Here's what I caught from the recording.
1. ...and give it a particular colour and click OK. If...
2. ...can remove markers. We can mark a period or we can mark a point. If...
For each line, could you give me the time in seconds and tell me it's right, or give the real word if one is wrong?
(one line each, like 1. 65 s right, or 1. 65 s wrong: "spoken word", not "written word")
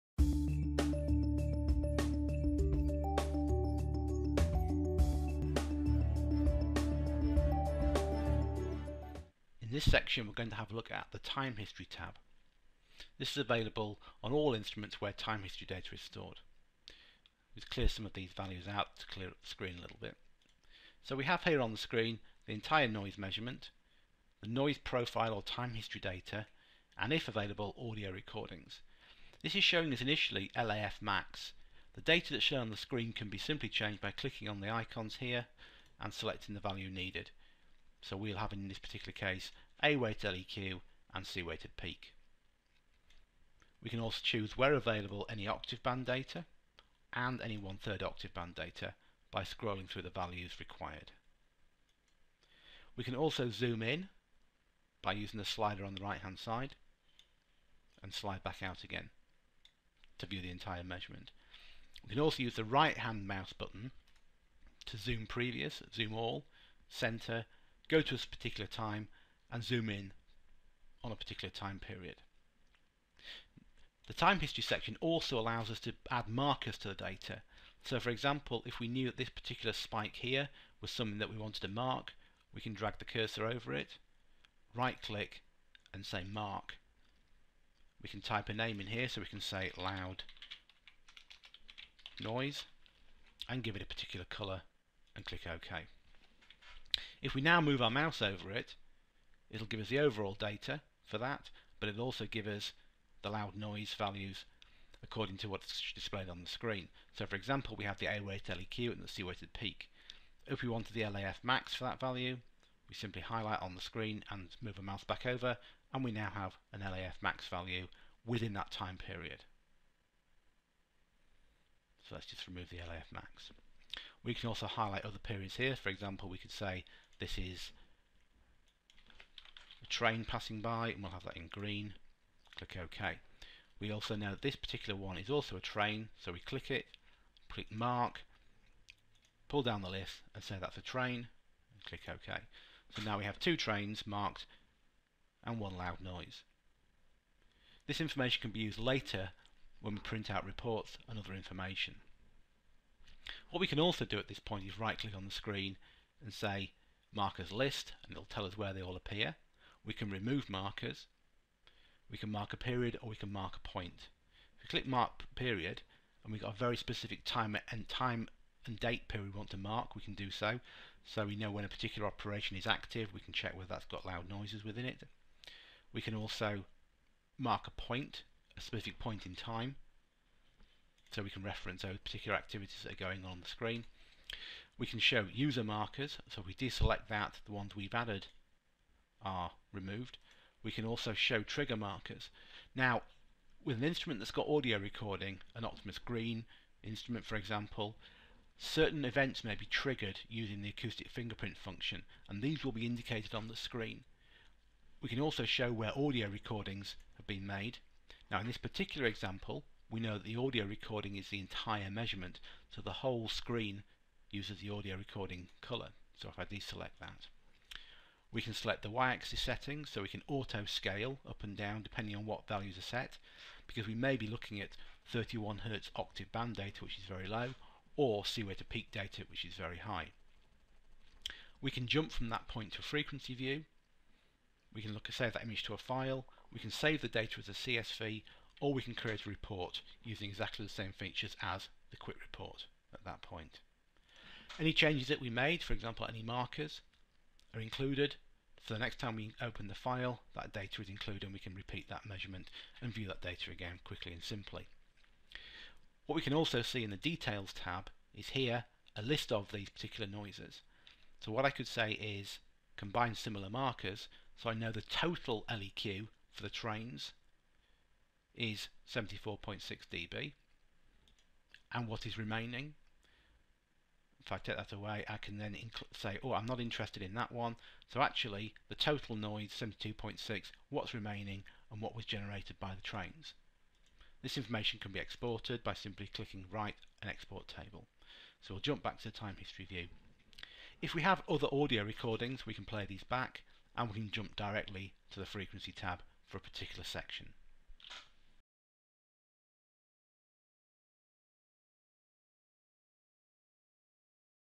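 1. 93 s right
2. 159 s right.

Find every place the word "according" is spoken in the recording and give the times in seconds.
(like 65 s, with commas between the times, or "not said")
105 s.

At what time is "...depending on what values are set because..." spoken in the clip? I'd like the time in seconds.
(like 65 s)
221 s.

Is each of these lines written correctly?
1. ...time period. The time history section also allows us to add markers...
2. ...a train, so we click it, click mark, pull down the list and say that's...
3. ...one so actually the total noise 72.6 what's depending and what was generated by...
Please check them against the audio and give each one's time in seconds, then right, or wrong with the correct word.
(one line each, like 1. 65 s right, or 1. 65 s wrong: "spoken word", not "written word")
1. 71 s right
2. 135 s right
3. 277 s wrong: "remaining", not "depending".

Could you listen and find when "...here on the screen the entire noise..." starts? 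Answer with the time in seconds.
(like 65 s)
21 s.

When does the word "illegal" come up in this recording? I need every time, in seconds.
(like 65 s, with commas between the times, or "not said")
not said.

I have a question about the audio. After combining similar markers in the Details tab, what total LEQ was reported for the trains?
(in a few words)
74.6 dB.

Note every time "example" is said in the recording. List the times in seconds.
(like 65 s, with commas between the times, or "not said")
78 s, 107 s, 125 s, 197 s, 209 s, 245 s.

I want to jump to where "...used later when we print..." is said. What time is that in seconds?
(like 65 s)
148 s.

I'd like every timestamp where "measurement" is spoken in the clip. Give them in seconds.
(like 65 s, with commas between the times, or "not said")
23 s, 60 s, 211 s, 252 s.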